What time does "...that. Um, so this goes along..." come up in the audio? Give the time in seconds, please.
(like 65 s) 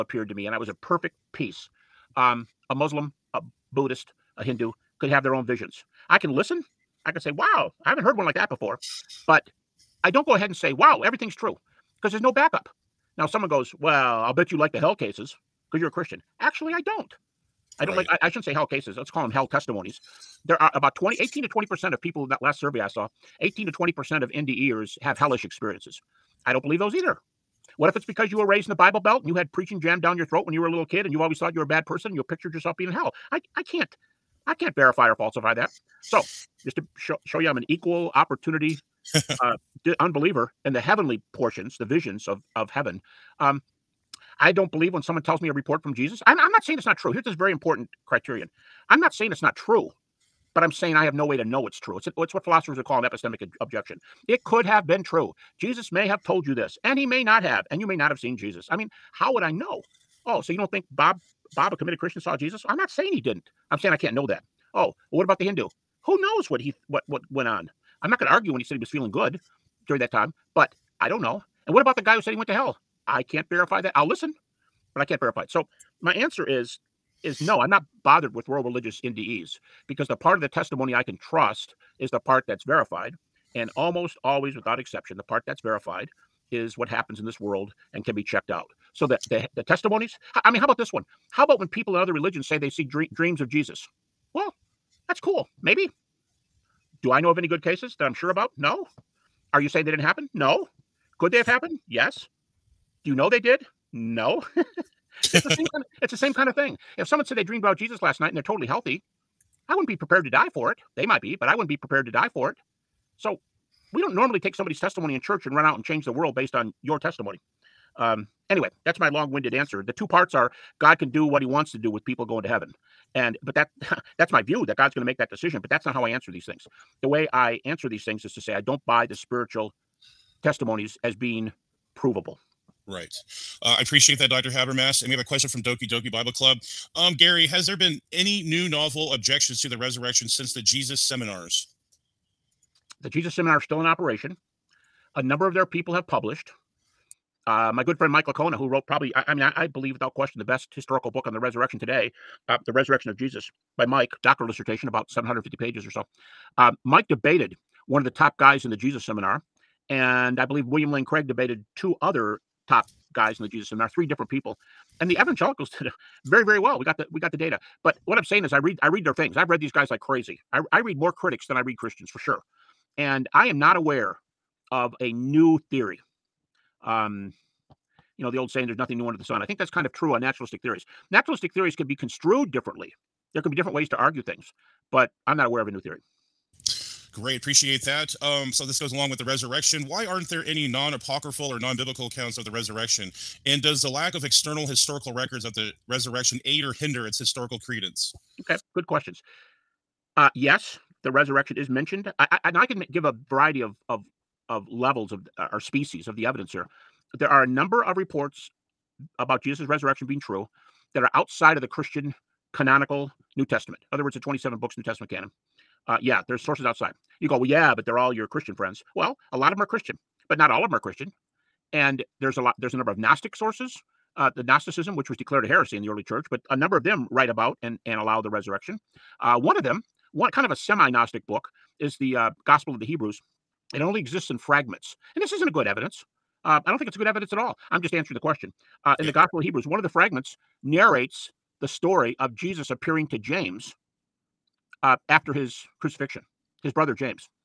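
187 s.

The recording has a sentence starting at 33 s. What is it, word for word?
I I can't I can't verify or falsify that.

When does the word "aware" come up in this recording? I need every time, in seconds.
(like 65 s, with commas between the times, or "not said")
173 s, 185 s.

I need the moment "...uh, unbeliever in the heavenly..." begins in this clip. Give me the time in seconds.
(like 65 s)
39 s.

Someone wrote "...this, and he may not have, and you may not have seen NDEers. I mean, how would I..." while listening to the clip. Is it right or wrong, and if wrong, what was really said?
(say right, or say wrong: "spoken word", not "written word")
wrong: "Jesus", not "NDEers".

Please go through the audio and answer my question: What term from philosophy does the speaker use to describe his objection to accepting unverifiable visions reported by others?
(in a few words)
epistemic objection.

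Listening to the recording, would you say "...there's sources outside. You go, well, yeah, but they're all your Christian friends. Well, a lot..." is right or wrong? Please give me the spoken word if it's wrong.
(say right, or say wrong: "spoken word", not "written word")
right.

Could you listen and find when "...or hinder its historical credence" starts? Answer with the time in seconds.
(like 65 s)
196 s.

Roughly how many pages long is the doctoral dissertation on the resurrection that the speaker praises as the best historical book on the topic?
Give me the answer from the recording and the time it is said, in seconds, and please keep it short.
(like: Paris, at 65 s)
750, at 155 s.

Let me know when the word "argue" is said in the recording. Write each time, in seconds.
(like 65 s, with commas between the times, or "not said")
68 s, 183 s.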